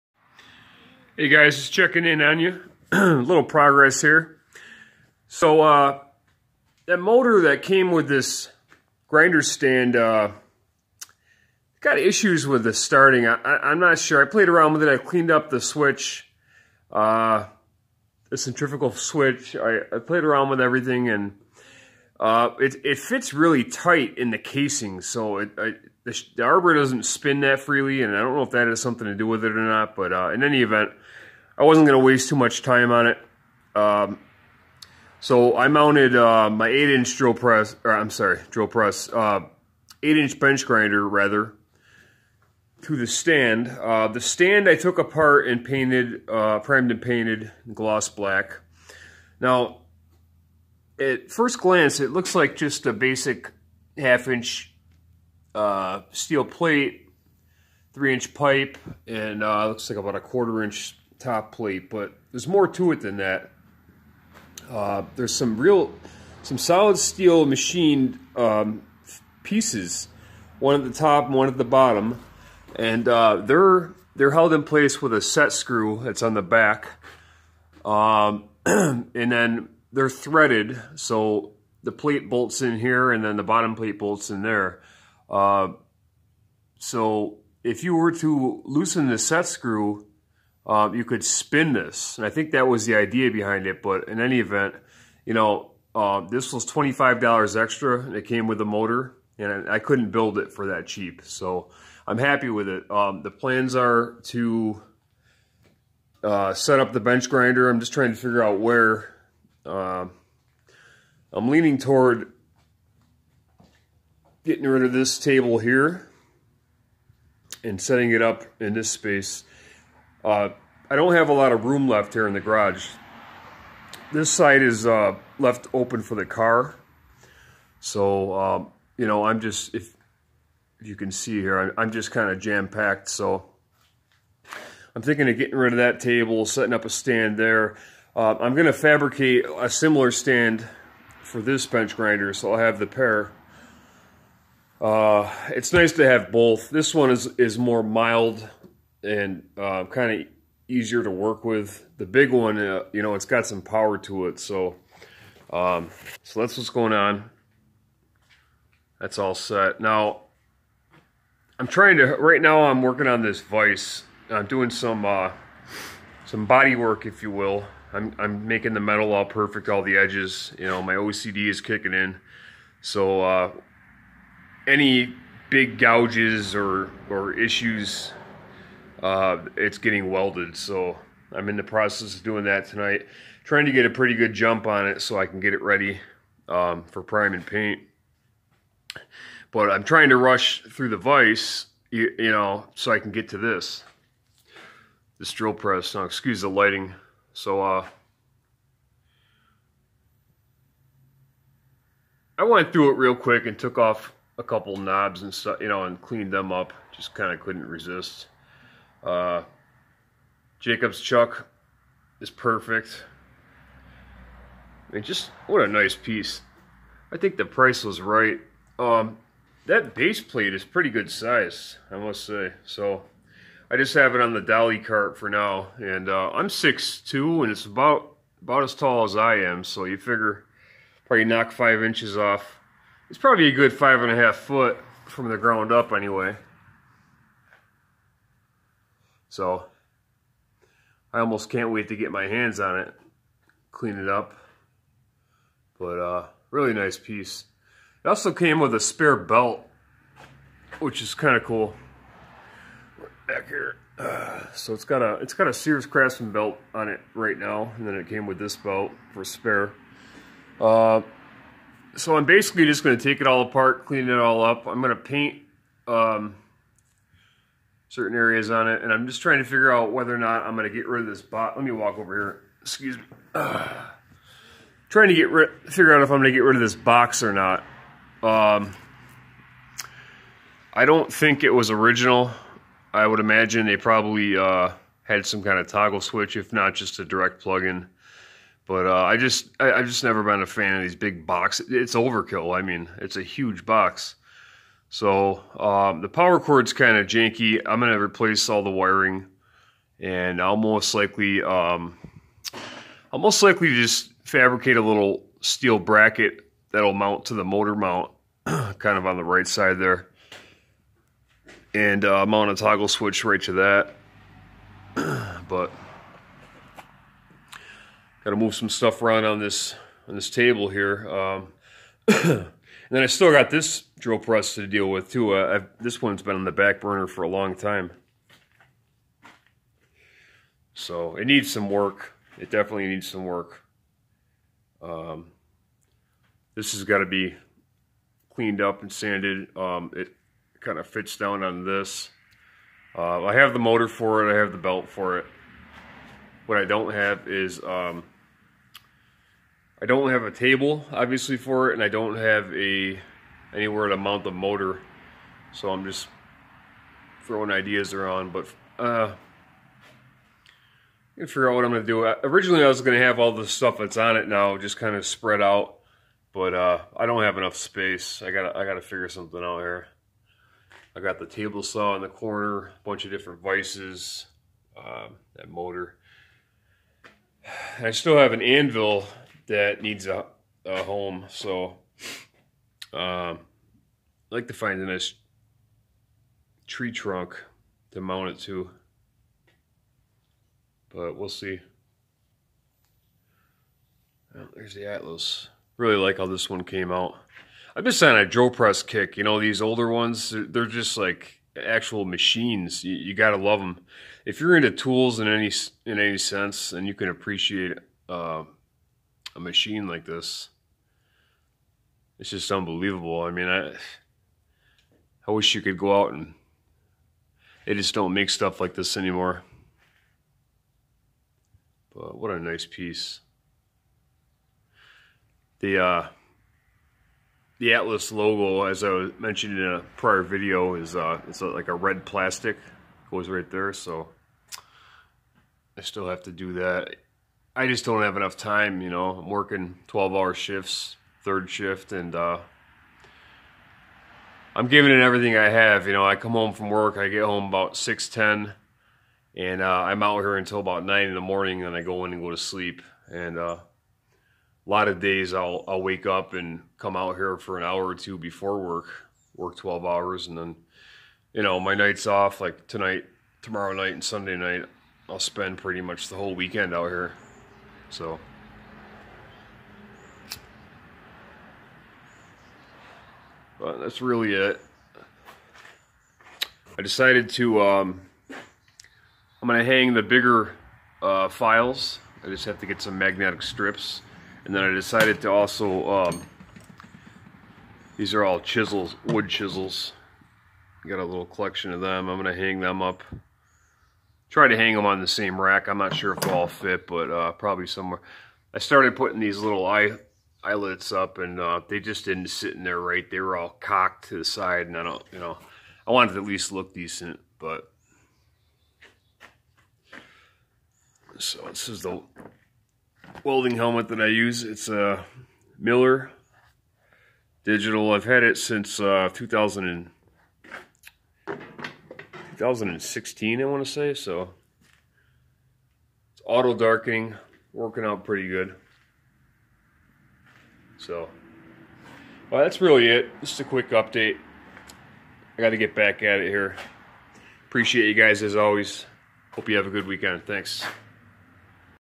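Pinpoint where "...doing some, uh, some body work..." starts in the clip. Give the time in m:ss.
2:44.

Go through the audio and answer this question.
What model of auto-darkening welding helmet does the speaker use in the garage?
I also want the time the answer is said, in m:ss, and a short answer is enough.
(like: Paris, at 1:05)
Miller Digital, at 8:35.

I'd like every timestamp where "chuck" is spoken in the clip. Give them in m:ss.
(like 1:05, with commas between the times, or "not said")
3:30.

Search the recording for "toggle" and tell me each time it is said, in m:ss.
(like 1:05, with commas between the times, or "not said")
4:45, 5:12.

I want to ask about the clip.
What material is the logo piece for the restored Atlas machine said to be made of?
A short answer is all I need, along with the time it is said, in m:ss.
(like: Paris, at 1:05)
red plastic, at 7:11.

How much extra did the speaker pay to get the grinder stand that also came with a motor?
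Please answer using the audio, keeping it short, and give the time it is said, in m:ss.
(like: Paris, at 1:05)
$25, at 1:36.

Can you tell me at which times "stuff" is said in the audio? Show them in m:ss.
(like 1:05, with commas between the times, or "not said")
3:25, 5:18, 6:03, 6:58.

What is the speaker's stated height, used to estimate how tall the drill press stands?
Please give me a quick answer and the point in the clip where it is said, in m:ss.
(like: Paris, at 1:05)
6'2", at 3:46.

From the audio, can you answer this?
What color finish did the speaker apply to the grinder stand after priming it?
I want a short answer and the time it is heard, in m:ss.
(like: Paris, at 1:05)
gloss black, at 0:47.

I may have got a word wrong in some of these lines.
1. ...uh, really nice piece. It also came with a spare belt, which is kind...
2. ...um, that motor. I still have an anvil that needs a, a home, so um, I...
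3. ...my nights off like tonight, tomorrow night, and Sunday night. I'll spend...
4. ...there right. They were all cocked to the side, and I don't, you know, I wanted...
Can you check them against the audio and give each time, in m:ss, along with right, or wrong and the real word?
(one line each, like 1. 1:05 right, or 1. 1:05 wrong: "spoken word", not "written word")
1. 4:05 right
2. 6:14 right
3. 7:41 right
4. 8:22 right.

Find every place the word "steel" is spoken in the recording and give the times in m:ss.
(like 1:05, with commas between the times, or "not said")
0:56, 1:06, 5:05.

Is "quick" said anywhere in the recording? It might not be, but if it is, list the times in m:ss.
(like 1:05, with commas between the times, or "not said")
3:23, 8:53.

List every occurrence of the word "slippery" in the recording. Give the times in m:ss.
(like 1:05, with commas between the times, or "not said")
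not said.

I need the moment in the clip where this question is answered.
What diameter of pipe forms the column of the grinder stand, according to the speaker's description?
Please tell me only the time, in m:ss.
0:57.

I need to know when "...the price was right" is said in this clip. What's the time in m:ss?
3:37.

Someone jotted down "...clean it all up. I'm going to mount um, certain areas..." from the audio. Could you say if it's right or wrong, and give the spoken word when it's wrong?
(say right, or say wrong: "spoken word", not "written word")
wrong: "paint", not "mount".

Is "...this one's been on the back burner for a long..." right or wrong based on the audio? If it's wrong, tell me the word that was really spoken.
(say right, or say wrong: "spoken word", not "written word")
right.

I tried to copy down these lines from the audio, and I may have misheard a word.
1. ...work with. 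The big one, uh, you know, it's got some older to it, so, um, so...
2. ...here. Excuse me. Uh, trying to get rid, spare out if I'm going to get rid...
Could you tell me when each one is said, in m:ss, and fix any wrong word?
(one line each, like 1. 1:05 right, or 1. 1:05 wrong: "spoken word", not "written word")
1. 2:31 wrong: "power", not "older"
2. 4:32 wrong: "figure", not "spare".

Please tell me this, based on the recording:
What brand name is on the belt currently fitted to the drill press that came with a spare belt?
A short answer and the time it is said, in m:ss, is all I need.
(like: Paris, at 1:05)
Sears Craftsman, at 4:15.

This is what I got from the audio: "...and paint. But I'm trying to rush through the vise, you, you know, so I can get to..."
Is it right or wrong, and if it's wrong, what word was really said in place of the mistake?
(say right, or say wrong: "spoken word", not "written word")
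right.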